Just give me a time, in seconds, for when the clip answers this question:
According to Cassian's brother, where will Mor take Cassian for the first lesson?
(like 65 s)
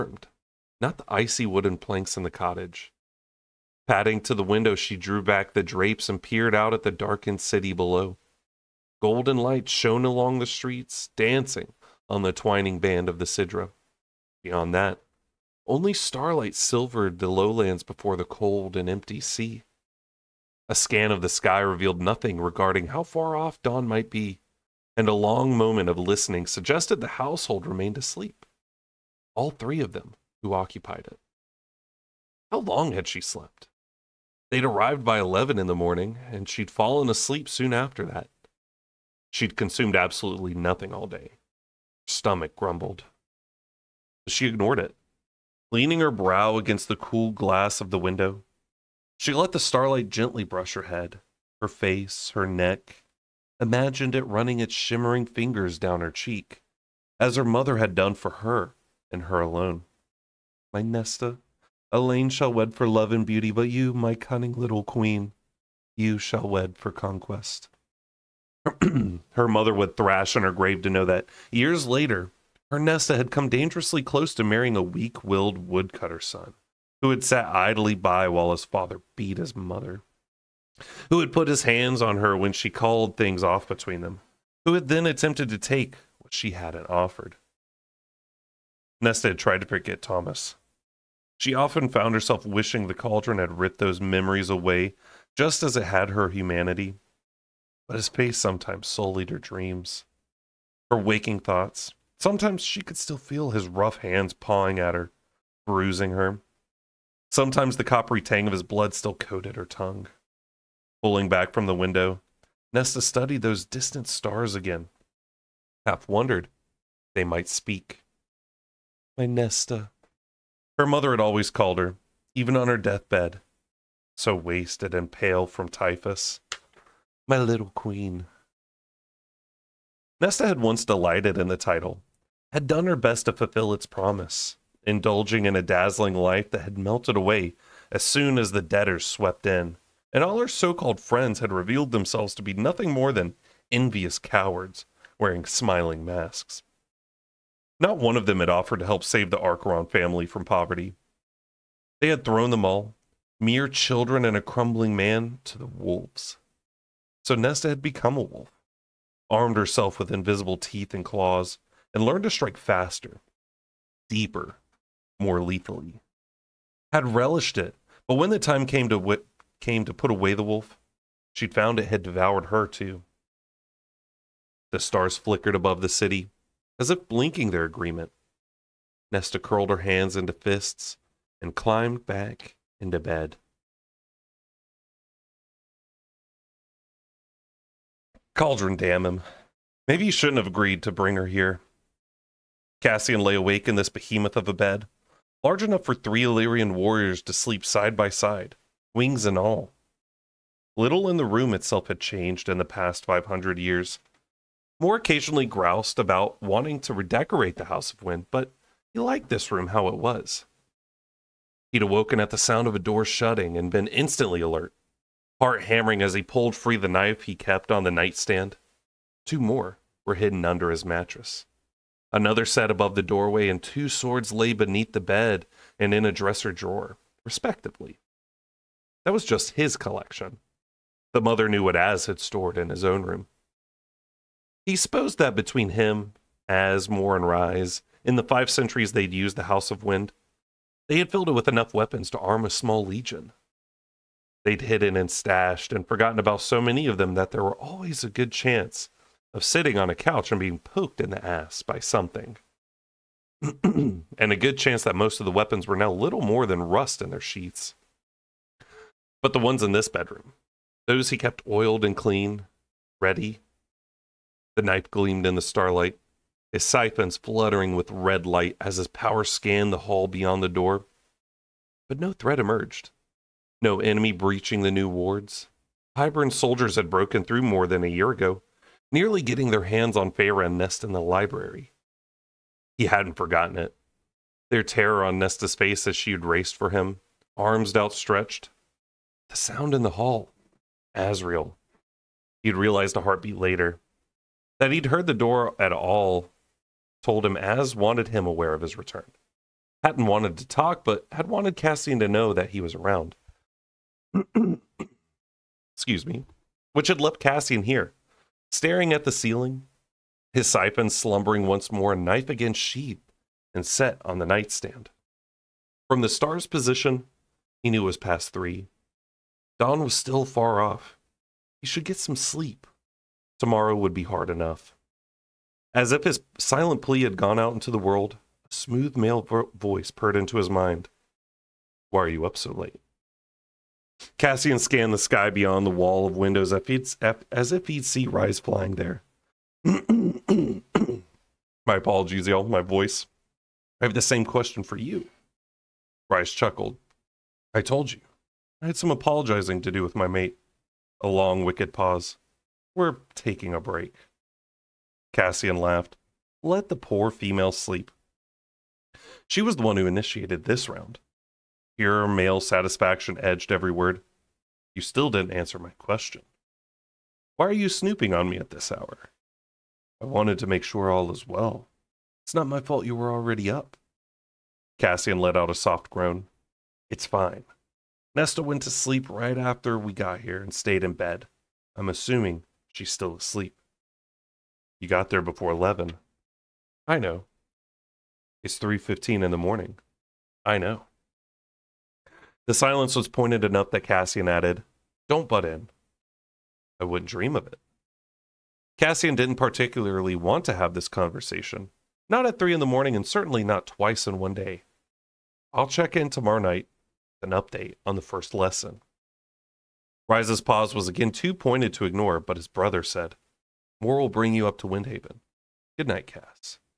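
414 s.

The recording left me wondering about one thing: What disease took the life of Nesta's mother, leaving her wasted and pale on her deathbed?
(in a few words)
typhus.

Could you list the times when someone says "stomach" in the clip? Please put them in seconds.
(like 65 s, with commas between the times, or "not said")
42 s.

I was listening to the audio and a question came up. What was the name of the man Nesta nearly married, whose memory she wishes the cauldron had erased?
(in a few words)
Thomas.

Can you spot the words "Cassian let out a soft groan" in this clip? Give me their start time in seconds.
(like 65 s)
374 s.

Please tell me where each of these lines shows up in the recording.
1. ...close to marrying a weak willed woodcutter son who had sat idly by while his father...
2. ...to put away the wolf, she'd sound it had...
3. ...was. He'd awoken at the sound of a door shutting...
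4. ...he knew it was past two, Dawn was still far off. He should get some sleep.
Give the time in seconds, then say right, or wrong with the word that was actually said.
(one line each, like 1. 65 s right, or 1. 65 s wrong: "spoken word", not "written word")
1. 74 s right
2. 169 s wrong: "found", not "sound"
3. 209 s right
4. 317 s wrong: "three", not "two".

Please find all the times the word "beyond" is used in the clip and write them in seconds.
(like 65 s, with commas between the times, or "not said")
14 s, 270 s, 335 s.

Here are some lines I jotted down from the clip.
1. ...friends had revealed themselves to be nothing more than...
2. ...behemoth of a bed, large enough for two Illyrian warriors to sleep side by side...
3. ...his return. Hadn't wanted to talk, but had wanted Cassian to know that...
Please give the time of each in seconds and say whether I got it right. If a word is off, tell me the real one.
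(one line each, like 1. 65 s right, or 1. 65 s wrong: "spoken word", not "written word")
1. 140 s right
2. 193 s wrong: "three", not "two"
3. 298 s right.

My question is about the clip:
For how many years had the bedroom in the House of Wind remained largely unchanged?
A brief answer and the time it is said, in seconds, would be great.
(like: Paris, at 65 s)
500, at 203 s.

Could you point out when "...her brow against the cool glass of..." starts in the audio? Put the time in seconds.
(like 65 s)
45 s.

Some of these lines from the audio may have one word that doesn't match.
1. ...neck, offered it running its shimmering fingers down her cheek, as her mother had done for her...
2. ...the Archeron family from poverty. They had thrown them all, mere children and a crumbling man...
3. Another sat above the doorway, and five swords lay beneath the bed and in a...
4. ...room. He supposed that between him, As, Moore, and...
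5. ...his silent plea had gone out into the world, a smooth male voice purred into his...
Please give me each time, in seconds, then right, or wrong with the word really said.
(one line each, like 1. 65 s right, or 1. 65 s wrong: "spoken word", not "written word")
1. 52 s wrong: "imagined", not "offered"
2. 149 s right
3. 222 s wrong: "two", not "five"
4. 233 s right
5. 326 s right.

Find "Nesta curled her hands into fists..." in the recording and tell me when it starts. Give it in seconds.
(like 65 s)
179 s.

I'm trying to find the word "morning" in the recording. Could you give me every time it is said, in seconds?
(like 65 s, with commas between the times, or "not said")
35 s, 389 s, 402 s.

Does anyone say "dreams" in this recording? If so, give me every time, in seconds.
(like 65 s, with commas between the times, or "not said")
99 s, 397 s.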